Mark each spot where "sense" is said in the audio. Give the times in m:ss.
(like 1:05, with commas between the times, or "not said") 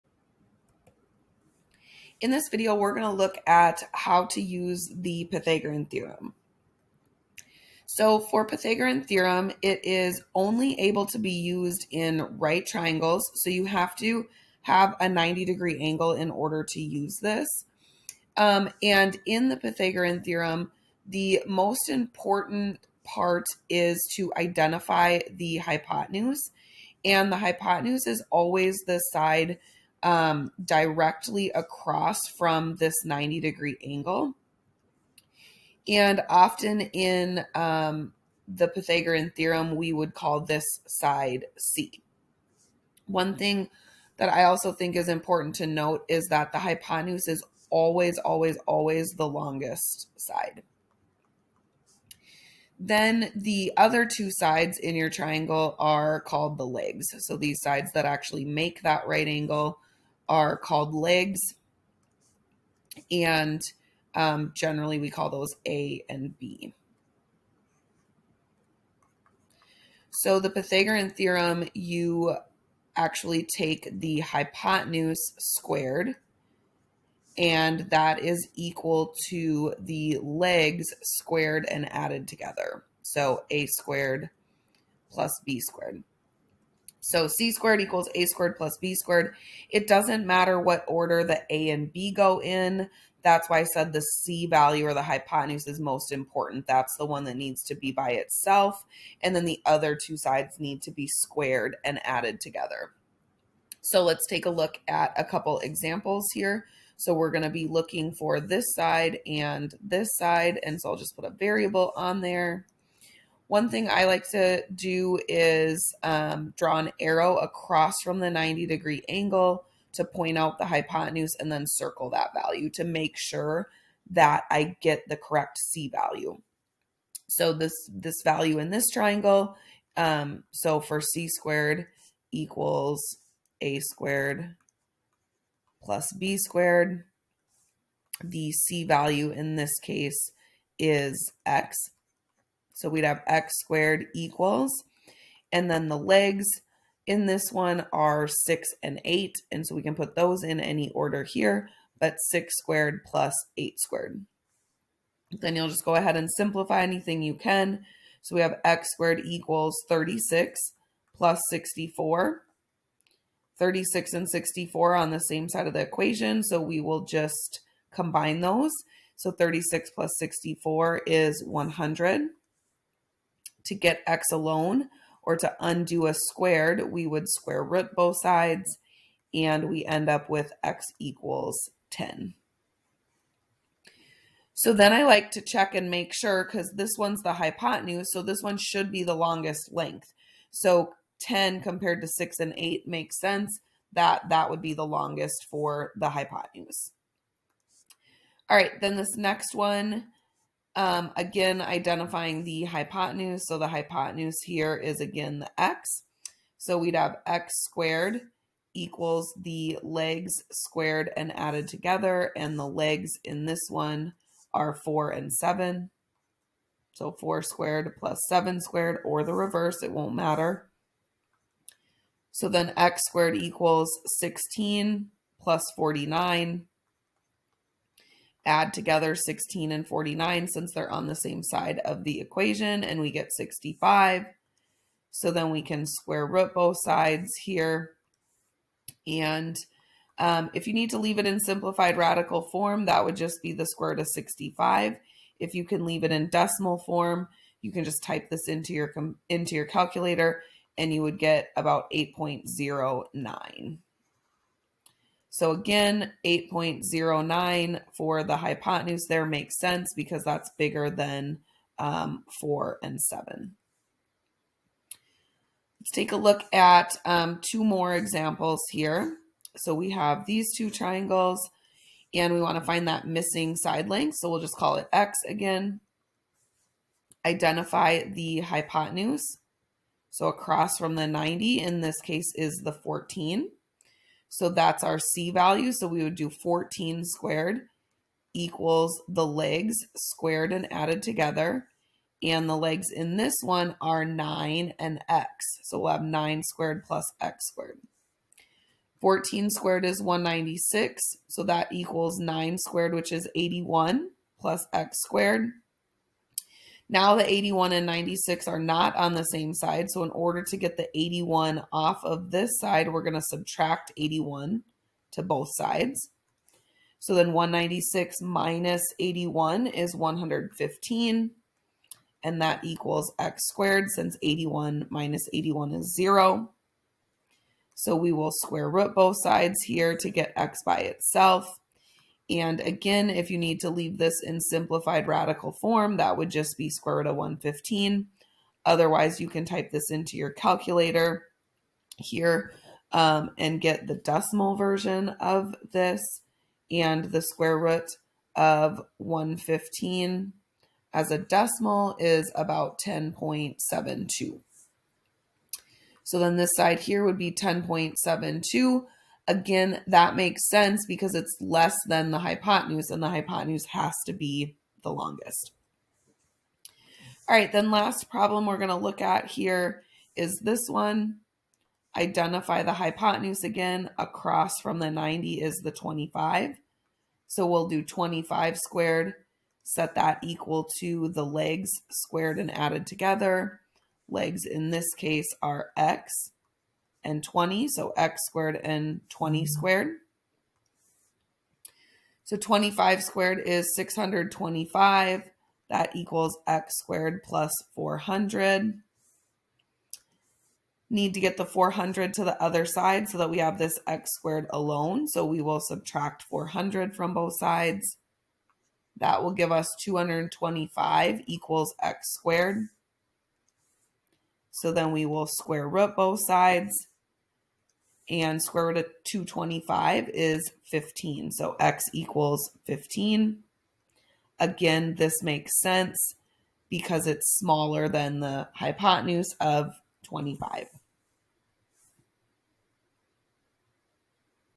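3:13, 4:19, 6:00, 7:05.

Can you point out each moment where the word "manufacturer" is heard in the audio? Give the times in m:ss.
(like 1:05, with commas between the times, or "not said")
not said.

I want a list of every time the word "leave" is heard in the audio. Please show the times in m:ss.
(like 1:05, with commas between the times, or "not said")
4:00, 4:05, 5:33.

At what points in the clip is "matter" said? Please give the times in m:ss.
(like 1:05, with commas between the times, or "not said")
1:30, 3:40.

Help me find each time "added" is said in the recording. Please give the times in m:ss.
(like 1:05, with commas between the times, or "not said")
1:21, 1:42, 3:31, 4:50, 6:22.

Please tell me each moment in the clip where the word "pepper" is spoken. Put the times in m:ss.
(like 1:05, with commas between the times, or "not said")
not said.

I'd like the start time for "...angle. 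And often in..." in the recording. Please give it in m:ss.
0:33.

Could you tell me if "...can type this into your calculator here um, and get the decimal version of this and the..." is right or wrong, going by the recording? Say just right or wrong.
right.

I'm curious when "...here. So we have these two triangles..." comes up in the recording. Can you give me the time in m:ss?
4:28.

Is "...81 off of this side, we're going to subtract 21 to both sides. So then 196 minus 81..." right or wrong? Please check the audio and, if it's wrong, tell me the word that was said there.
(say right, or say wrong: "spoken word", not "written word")
wrong: "81", not "21".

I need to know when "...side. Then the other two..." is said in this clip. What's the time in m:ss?
0:50.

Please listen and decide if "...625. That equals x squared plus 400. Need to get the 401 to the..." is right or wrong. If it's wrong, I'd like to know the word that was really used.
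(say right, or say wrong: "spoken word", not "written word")
wrong: "400", not "401".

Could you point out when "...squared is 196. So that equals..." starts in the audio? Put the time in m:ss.
4:59.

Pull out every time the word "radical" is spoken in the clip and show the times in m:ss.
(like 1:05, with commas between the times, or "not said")
4:01, 5:35.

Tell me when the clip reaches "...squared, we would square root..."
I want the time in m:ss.
2:56.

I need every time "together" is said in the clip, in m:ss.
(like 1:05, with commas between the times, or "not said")
1:22, 1:42, 3:31, 3:48, 4:51, 6:22.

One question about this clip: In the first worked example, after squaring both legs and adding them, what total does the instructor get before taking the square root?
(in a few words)
100.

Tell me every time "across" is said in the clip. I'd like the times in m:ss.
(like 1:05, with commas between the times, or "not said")
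0:31, 1:57, 4:40, 6:13.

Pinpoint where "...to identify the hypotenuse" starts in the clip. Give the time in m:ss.
0:24.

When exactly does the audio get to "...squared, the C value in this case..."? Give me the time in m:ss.
2:16.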